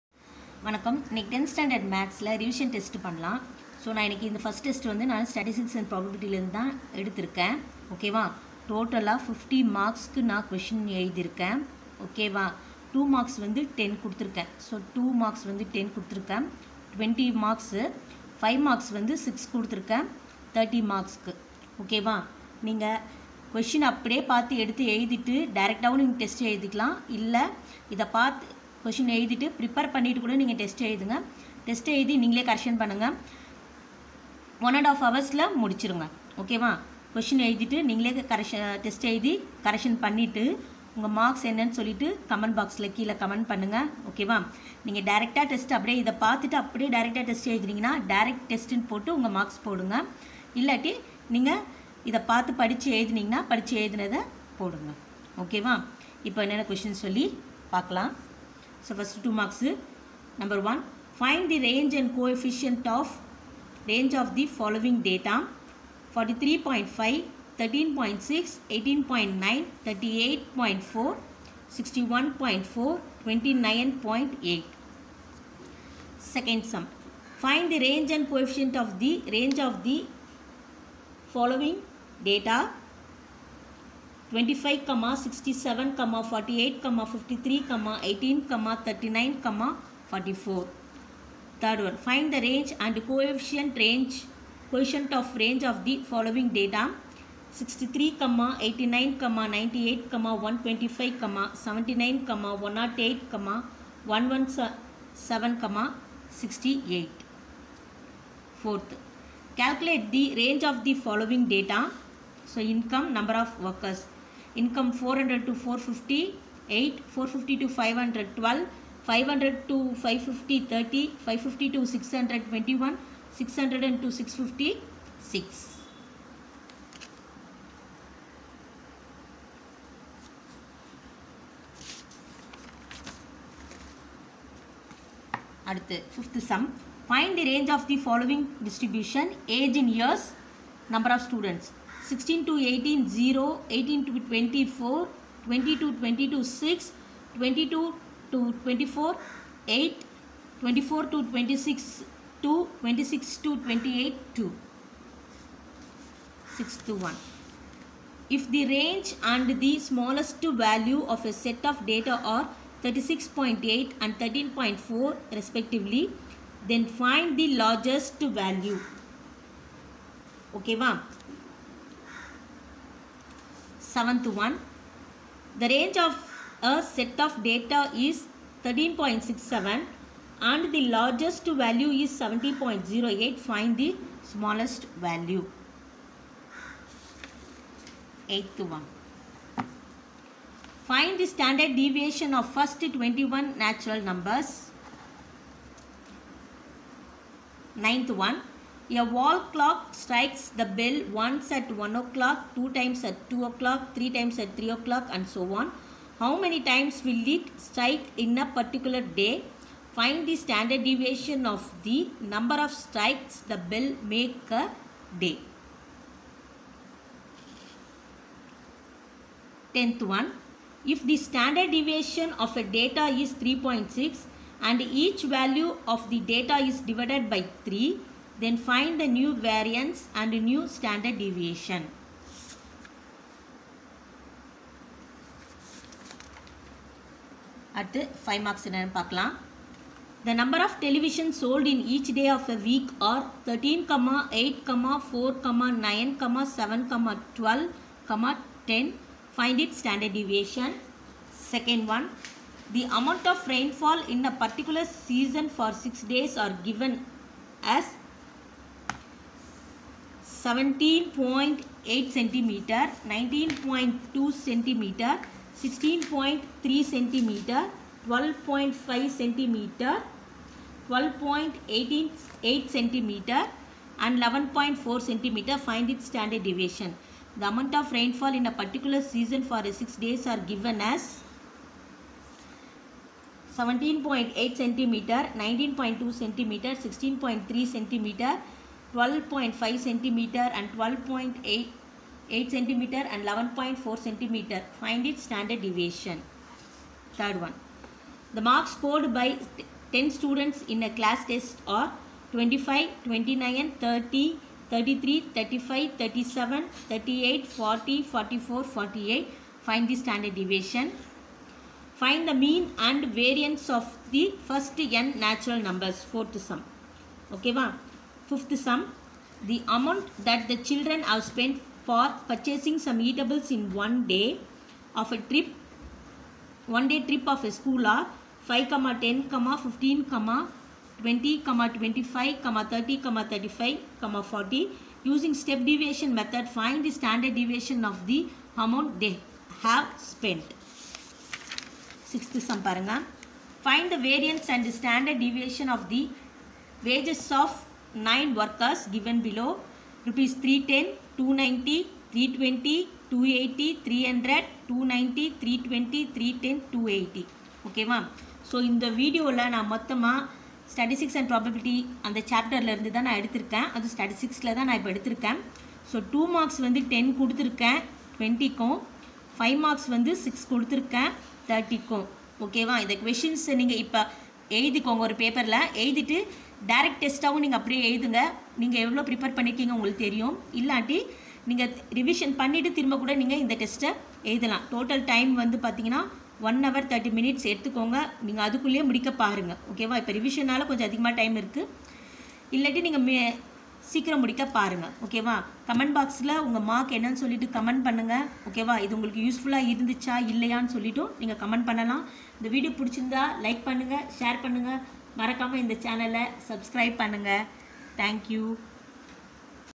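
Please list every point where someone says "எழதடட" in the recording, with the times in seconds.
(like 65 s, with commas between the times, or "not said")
24 s, 29 s, 37 s, 375 s.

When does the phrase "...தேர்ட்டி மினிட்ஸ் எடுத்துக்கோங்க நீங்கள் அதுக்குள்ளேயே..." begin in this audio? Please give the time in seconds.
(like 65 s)
386 s.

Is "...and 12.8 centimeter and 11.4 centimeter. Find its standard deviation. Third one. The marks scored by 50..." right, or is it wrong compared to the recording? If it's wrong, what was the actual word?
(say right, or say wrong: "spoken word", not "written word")
wrong: "10", not "50".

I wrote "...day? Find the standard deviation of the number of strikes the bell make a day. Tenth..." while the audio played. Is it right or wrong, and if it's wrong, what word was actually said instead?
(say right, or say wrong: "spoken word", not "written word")
right.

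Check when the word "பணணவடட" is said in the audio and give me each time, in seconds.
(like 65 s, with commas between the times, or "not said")
29 s, 40 s, 382 s.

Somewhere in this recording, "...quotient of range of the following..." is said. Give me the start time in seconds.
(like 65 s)
94 s.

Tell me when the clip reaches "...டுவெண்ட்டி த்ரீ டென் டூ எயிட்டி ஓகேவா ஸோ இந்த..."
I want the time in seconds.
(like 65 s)
355 s.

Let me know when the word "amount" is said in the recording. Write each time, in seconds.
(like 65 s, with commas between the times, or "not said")
252 s, 277 s, 319 s, 338 s.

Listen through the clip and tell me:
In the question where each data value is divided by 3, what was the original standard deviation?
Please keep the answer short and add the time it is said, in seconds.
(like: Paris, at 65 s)
3.6, at 223 s.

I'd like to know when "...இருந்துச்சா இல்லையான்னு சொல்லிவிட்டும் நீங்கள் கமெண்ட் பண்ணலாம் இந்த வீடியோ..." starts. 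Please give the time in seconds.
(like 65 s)
399 s.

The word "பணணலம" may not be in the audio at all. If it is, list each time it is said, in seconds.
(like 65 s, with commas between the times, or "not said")
3 s, 401 s.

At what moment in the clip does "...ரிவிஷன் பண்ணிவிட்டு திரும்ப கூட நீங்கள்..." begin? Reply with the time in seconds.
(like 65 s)
381 s.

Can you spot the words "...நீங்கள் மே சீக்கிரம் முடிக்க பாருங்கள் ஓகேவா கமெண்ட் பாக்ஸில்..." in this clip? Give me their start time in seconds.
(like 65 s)
392 s.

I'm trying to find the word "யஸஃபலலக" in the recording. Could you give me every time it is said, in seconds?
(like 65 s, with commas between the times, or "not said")
399 s.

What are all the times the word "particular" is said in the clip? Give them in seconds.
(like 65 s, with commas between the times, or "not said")
208 s, 254 s, 278 s.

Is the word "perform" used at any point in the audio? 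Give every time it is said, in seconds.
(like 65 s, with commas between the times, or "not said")
not said.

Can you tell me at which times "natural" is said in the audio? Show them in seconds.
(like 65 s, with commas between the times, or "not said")
193 s, 315 s.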